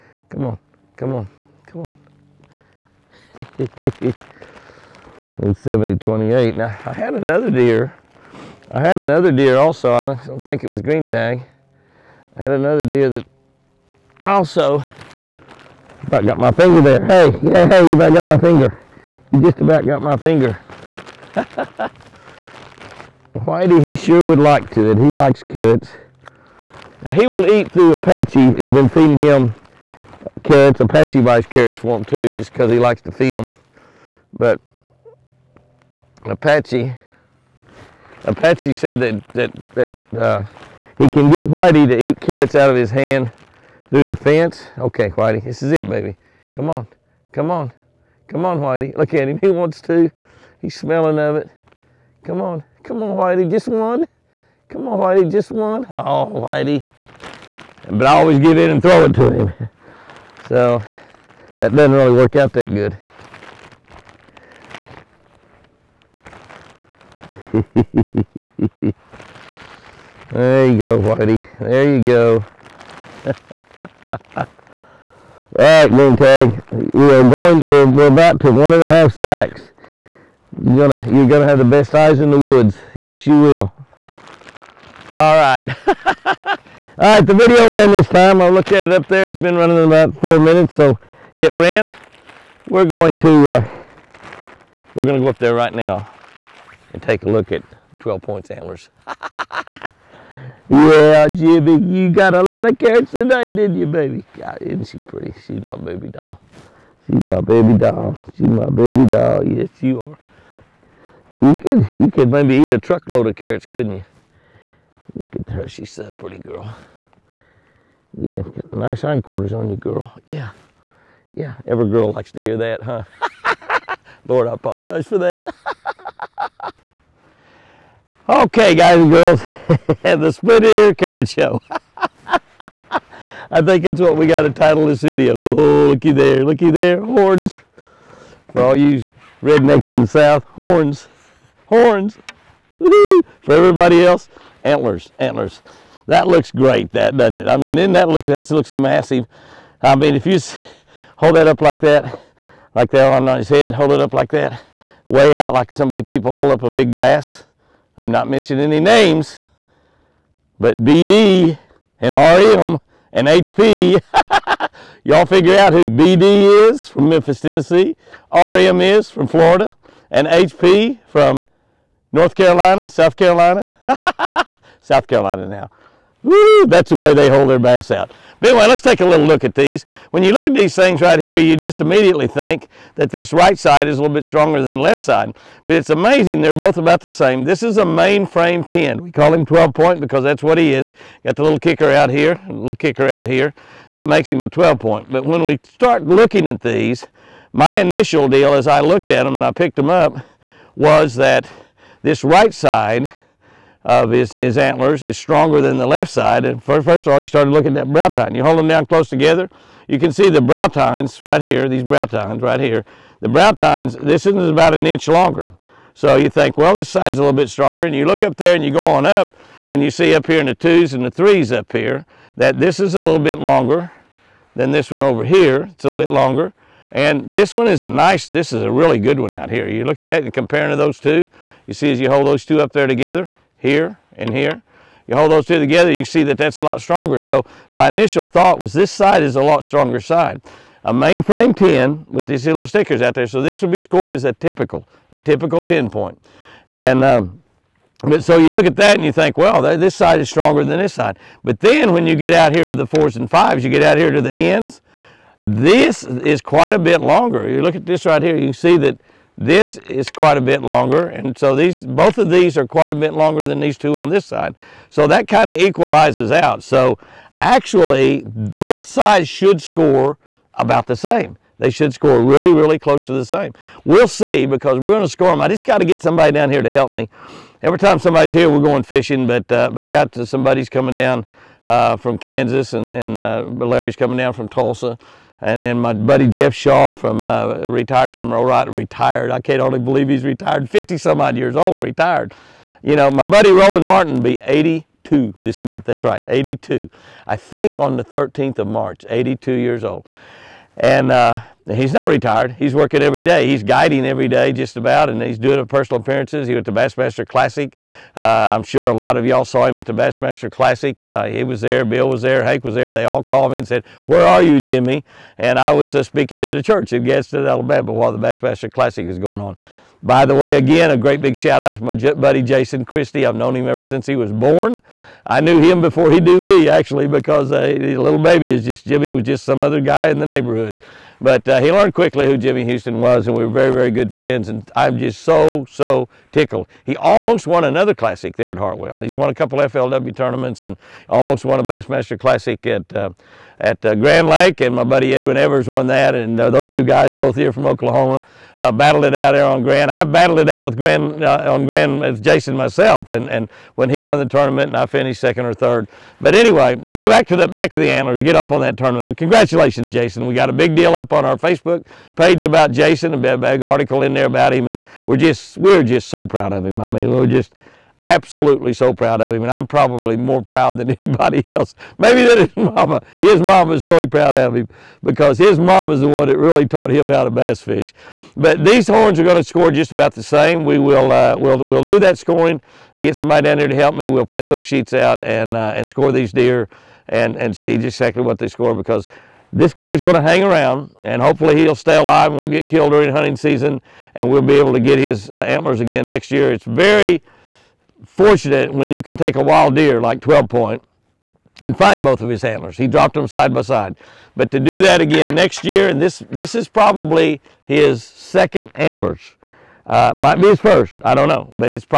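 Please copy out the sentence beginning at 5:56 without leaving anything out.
But anyway, go back to the back to the antlers, get off on that tournament.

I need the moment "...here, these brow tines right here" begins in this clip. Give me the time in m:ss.
3:31.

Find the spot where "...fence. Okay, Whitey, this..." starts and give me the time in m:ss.
0:44.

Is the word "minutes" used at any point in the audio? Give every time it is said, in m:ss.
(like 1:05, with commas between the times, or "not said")
1:30.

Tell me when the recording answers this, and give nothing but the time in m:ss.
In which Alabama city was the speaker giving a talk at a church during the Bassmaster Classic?
5:17.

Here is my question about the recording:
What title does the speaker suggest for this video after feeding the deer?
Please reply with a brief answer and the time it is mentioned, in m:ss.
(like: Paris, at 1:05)
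the split ear carrot show, at 2:10.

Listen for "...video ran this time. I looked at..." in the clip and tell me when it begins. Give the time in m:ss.
1:27.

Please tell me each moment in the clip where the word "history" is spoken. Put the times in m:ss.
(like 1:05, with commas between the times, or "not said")
not said.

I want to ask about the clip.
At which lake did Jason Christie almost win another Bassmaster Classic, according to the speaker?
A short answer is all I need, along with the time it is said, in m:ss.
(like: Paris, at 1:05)
Hartwell, at 5:38.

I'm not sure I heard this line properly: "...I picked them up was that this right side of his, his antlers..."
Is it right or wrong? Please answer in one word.
right.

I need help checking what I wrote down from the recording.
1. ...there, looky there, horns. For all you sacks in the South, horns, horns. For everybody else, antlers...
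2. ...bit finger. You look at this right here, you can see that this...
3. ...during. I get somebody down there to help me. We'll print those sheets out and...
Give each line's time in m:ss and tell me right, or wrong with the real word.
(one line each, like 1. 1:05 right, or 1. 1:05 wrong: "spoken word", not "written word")
1. 2:16 wrong: "rednecks", not "sacks"
2. 4:16 wrong: "longer", not "finger"
3. 6:22 wrong: "scoring", not "during".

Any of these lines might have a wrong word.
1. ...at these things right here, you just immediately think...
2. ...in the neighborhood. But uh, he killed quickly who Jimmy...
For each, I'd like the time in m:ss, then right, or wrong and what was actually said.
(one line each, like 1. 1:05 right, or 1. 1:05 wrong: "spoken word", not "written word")
1. 3:00 right
2. 5:30 wrong: "learned", not "killed".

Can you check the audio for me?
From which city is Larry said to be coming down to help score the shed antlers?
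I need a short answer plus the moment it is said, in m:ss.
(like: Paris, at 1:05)
Tulsa, at 4:44.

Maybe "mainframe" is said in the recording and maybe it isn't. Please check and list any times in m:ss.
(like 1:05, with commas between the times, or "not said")
3:07, 4:00.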